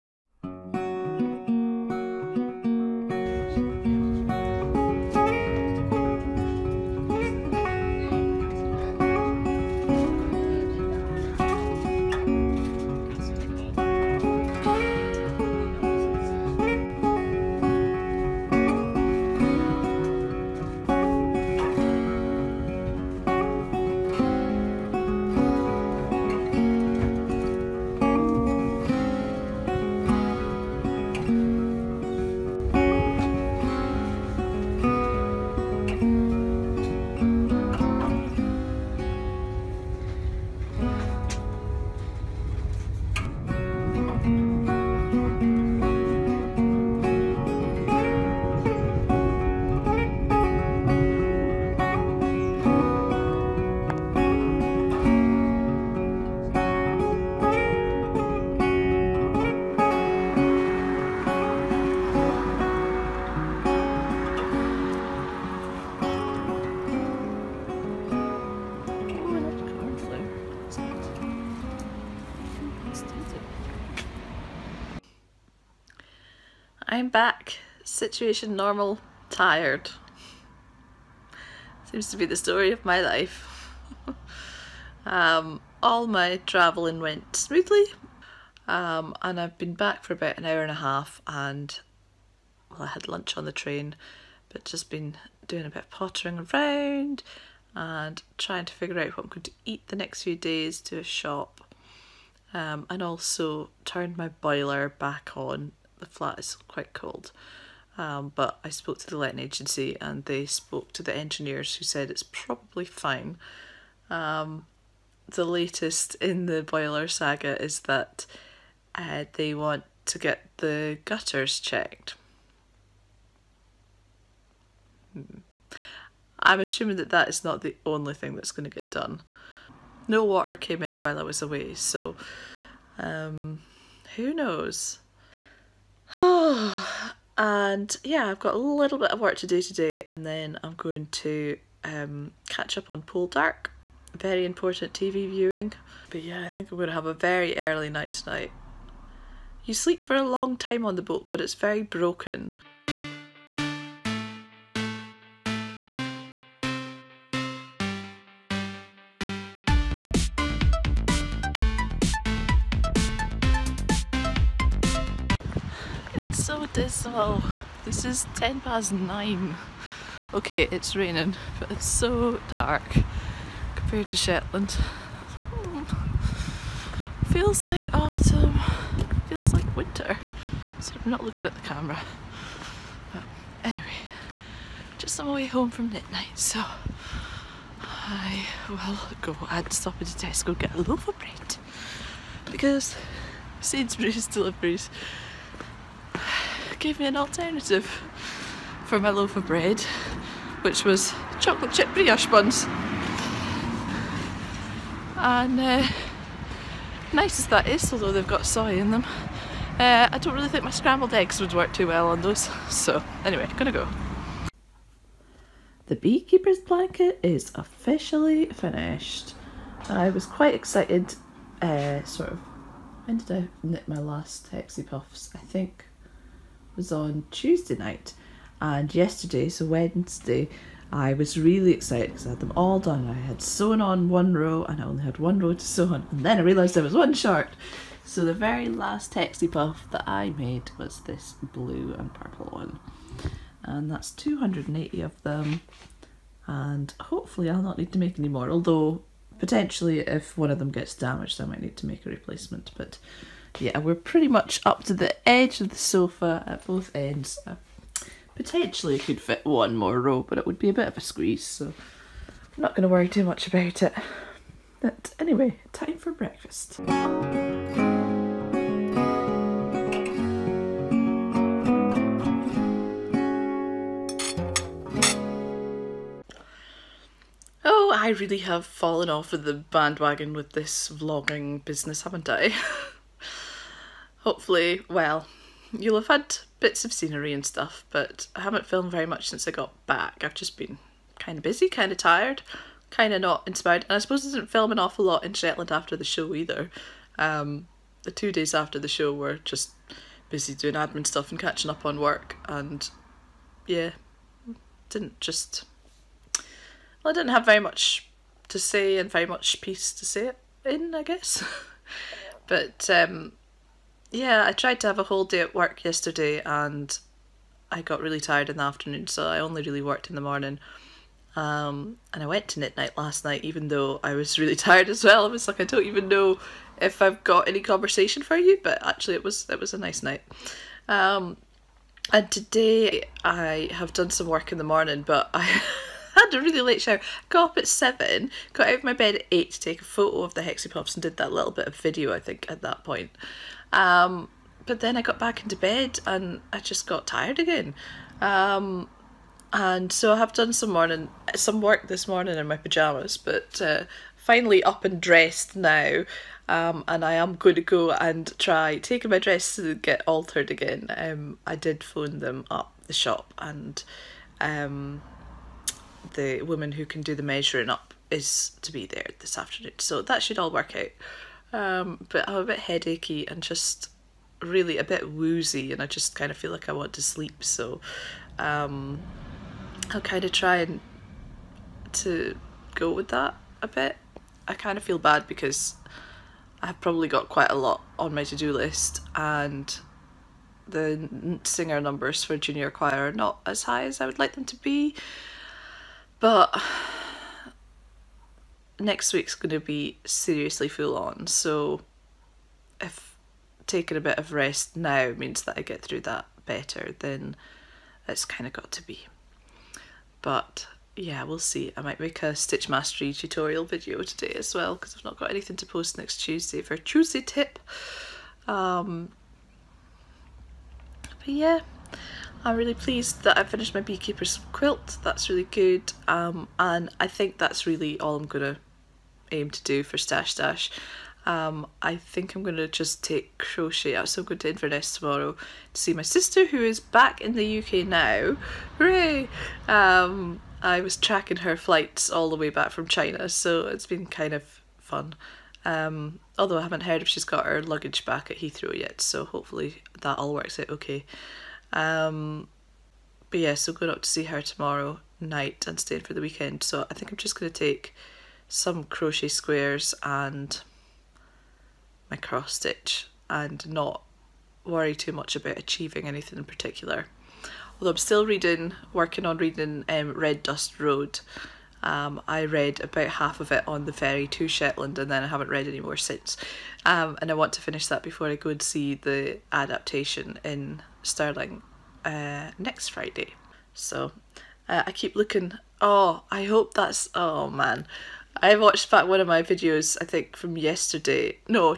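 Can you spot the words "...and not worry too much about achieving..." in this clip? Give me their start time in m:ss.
7:43.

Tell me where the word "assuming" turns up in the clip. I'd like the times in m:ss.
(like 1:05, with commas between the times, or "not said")
2:06.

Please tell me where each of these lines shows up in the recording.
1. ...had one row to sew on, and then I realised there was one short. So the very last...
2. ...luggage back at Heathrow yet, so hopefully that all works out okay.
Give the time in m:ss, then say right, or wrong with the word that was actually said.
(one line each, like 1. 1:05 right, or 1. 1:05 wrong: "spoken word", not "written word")
1. 3:55 right
2. 7:27 right.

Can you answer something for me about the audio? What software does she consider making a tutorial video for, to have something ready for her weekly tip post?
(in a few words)
Stitch Mastery.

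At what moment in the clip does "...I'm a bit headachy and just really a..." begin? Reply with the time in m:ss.
6:12.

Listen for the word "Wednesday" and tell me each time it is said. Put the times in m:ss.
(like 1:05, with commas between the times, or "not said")
3:49.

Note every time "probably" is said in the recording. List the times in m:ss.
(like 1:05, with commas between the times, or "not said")
1:52, 6:26.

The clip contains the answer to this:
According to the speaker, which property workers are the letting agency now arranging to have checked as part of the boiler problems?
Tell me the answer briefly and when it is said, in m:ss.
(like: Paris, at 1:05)
gutters, at 2:01.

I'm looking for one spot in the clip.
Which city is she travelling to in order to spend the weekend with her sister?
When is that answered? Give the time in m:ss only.
7:14.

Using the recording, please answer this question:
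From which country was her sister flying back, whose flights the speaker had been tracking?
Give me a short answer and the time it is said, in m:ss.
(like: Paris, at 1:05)
China, at 7:22.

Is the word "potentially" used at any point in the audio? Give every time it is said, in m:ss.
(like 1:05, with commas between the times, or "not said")
4:09, 4:18.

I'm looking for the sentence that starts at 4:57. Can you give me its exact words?
Um, the two days after the show were just busy doing admin stuff and catching up on work.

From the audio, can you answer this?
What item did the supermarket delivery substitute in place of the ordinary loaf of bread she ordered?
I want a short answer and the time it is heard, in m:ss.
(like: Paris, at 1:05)
chocolate chip brioche buns, at 3:21.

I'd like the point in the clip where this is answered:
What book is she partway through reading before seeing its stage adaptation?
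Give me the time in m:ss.
7:50.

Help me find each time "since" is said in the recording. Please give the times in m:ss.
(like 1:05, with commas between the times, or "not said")
4:49, 7:55.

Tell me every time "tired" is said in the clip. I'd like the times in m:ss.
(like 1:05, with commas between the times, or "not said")
1:19, 4:51, 5:18, 5:24, 5:47.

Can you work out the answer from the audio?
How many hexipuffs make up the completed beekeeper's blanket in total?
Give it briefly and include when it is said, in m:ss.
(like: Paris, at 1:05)
280, at 4:04.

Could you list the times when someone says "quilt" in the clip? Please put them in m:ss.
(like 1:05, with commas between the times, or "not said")
7:04.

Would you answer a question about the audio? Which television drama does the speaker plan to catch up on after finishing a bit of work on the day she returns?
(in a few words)
Poldark.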